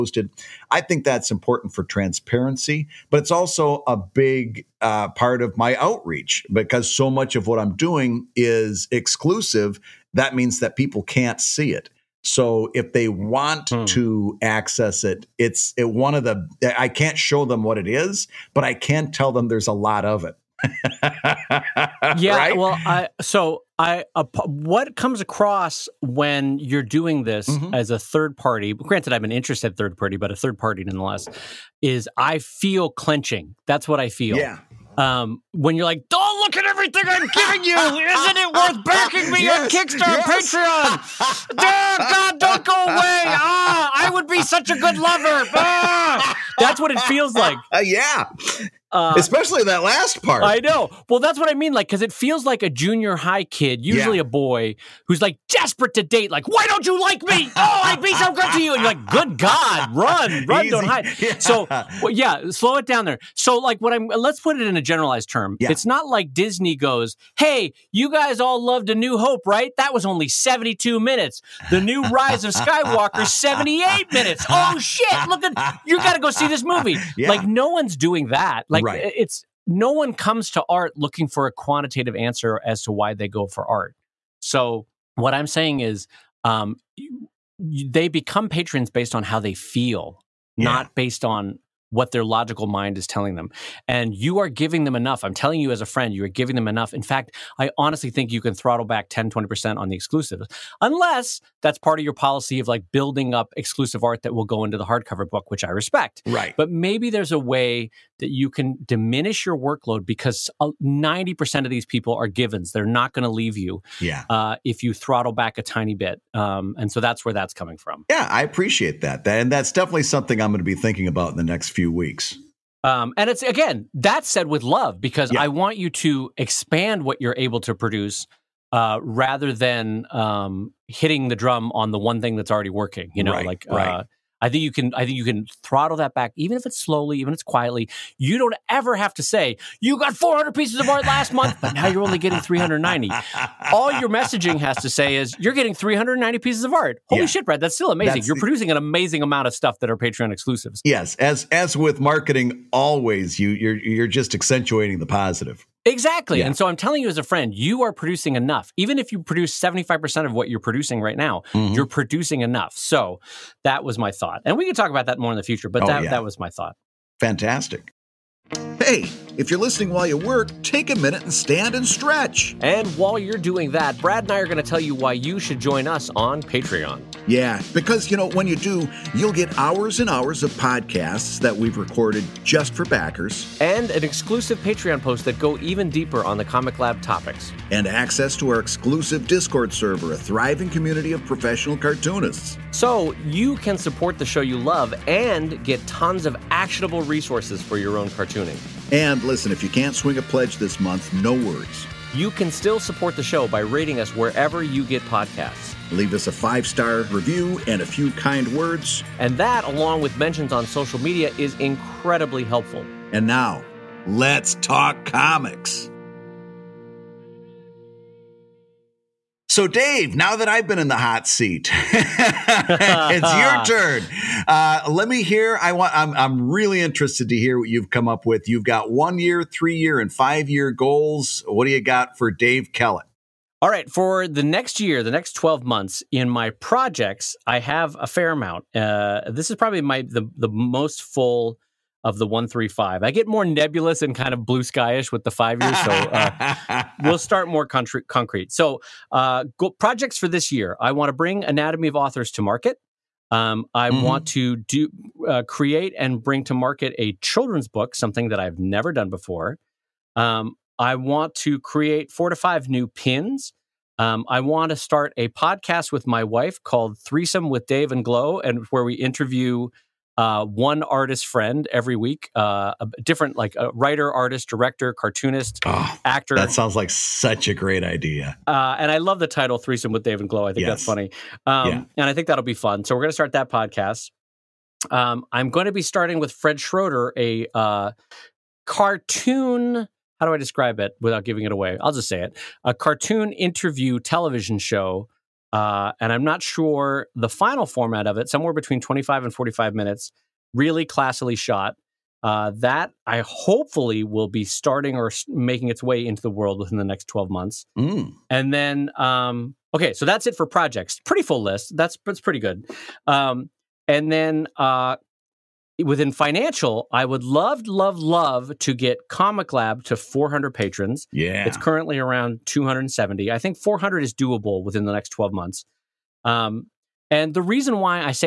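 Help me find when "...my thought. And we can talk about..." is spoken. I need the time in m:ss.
2:43.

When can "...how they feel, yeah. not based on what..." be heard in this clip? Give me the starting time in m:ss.
1:29.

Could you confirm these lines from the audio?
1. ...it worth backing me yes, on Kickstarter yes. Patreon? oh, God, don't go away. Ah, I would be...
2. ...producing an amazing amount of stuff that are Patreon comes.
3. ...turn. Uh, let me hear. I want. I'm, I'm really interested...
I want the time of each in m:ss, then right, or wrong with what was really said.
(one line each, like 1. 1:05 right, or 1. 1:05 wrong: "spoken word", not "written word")
1. 0:38 right
2. 2:28 wrong: "exclusives", not "comes"
3. 3:43 right.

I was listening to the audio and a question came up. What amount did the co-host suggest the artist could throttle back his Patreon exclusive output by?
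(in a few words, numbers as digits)
10, 20%.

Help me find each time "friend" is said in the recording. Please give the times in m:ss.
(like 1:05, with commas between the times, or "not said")
1:35, 2:37, 4:31.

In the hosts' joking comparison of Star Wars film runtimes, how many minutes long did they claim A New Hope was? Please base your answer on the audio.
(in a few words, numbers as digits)
72.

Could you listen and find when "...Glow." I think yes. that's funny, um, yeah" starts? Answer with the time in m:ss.
4:40.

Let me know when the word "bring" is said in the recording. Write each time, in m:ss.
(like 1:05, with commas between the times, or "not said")
4:11, 4:16.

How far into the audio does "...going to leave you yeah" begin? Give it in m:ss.
1:53.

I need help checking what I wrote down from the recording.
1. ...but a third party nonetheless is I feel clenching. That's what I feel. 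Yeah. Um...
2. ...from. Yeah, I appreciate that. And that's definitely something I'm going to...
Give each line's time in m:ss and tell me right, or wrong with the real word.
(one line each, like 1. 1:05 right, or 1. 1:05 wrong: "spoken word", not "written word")
1. 0:30 right
2. 1:57 right.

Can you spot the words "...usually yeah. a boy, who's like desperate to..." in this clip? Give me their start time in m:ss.
0:53.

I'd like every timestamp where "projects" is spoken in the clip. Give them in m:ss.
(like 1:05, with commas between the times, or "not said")
3:56, 4:09, 5:10.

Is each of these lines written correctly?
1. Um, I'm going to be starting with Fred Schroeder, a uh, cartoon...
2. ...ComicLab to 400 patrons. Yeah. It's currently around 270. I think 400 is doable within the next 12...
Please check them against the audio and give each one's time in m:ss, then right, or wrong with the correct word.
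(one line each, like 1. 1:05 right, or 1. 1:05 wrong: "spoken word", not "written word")
1. 4:44 right
2. 5:19 right.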